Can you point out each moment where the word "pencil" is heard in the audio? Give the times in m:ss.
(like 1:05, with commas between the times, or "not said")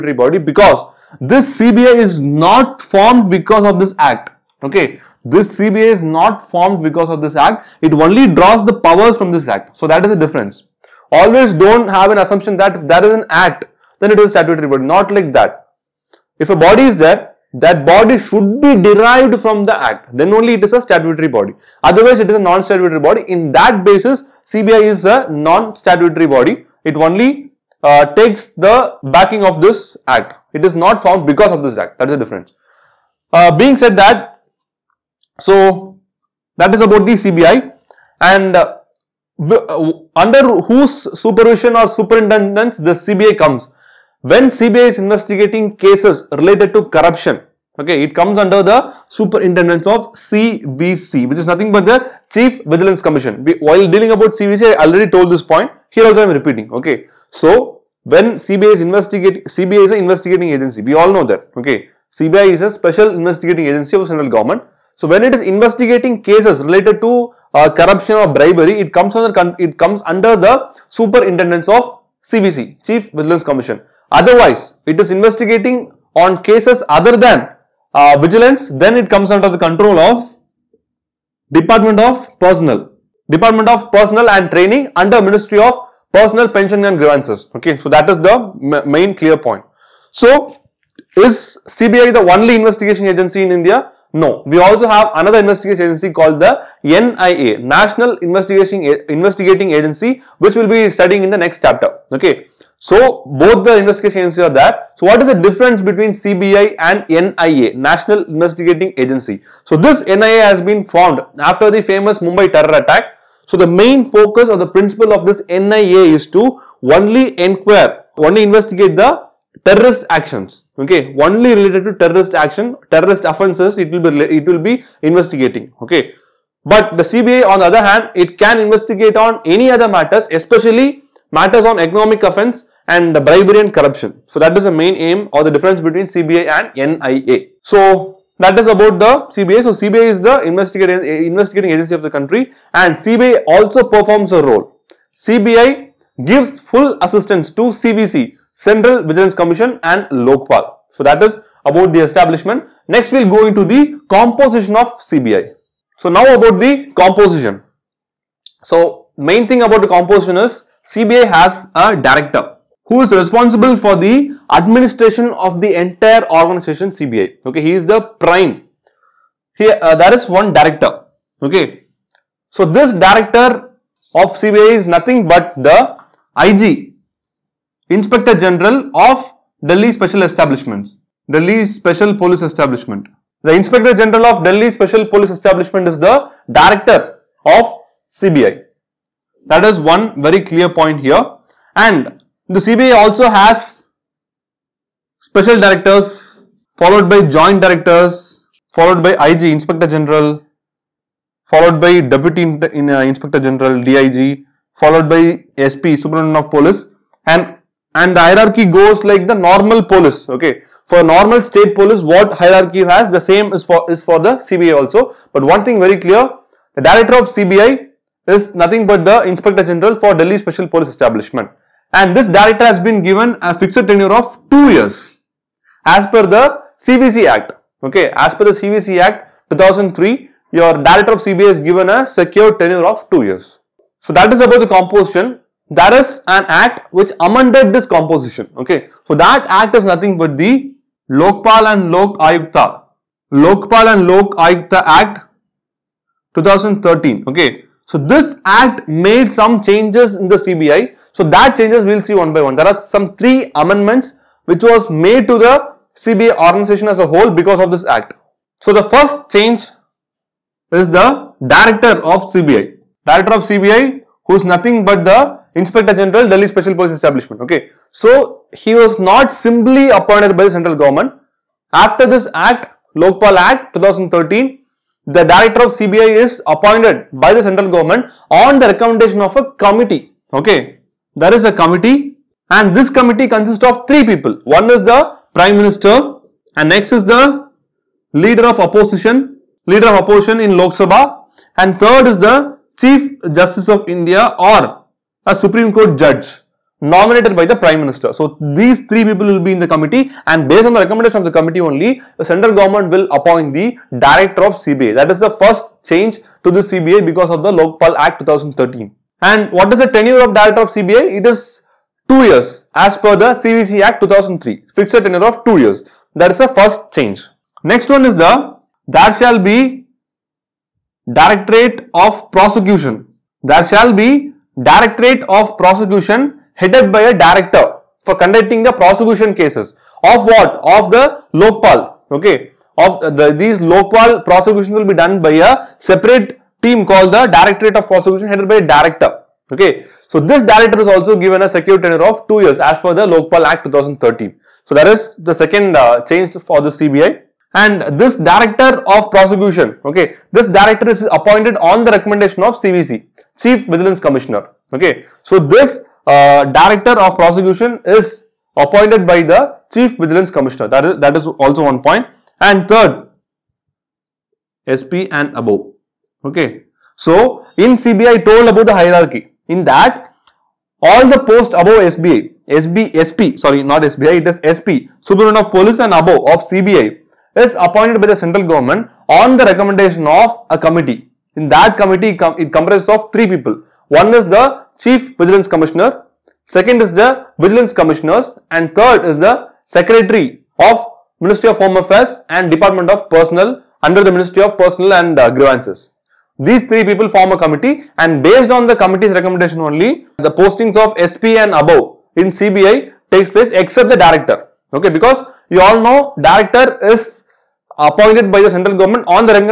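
not said.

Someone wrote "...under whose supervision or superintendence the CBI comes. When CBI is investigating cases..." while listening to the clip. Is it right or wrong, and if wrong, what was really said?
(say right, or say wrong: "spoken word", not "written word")
right.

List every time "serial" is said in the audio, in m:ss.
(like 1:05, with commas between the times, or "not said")
not said.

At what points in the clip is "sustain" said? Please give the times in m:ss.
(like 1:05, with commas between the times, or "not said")
not said.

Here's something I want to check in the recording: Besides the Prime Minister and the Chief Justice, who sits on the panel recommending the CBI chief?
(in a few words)
Leader of Opposition in Lok Sabha.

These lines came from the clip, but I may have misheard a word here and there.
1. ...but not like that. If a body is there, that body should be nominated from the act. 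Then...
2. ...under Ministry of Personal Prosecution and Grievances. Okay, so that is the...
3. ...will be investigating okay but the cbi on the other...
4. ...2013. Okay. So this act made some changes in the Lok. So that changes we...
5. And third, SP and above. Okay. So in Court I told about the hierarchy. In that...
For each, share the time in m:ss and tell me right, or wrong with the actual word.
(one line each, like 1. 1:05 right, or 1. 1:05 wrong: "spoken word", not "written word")
1. 0:14 wrong: "derived", not "nominated"
2. 1:24 wrong: "Pension", not "Prosecution"
3. 2:04 right
4. 4:06 wrong: "CBI", not "Lok"
5. 6:02 wrong: "CBI", not "Court".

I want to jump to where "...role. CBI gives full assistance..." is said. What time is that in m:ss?
2:24.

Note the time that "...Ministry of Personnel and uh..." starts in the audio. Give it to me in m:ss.
6:34.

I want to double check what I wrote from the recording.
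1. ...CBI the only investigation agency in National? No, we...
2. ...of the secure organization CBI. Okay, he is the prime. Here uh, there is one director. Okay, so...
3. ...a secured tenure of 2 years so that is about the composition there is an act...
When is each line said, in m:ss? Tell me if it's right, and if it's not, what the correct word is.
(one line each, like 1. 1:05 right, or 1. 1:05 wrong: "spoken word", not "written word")
1. 1:31 wrong: "India", not "National"
2. 2:45 wrong: "entire", not "secure"
3. 3:51 right.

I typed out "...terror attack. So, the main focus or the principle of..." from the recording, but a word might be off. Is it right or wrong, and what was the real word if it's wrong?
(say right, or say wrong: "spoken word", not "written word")
right.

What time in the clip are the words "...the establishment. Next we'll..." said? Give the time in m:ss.
2:31.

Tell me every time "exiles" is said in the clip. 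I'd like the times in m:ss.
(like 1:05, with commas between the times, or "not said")
not said.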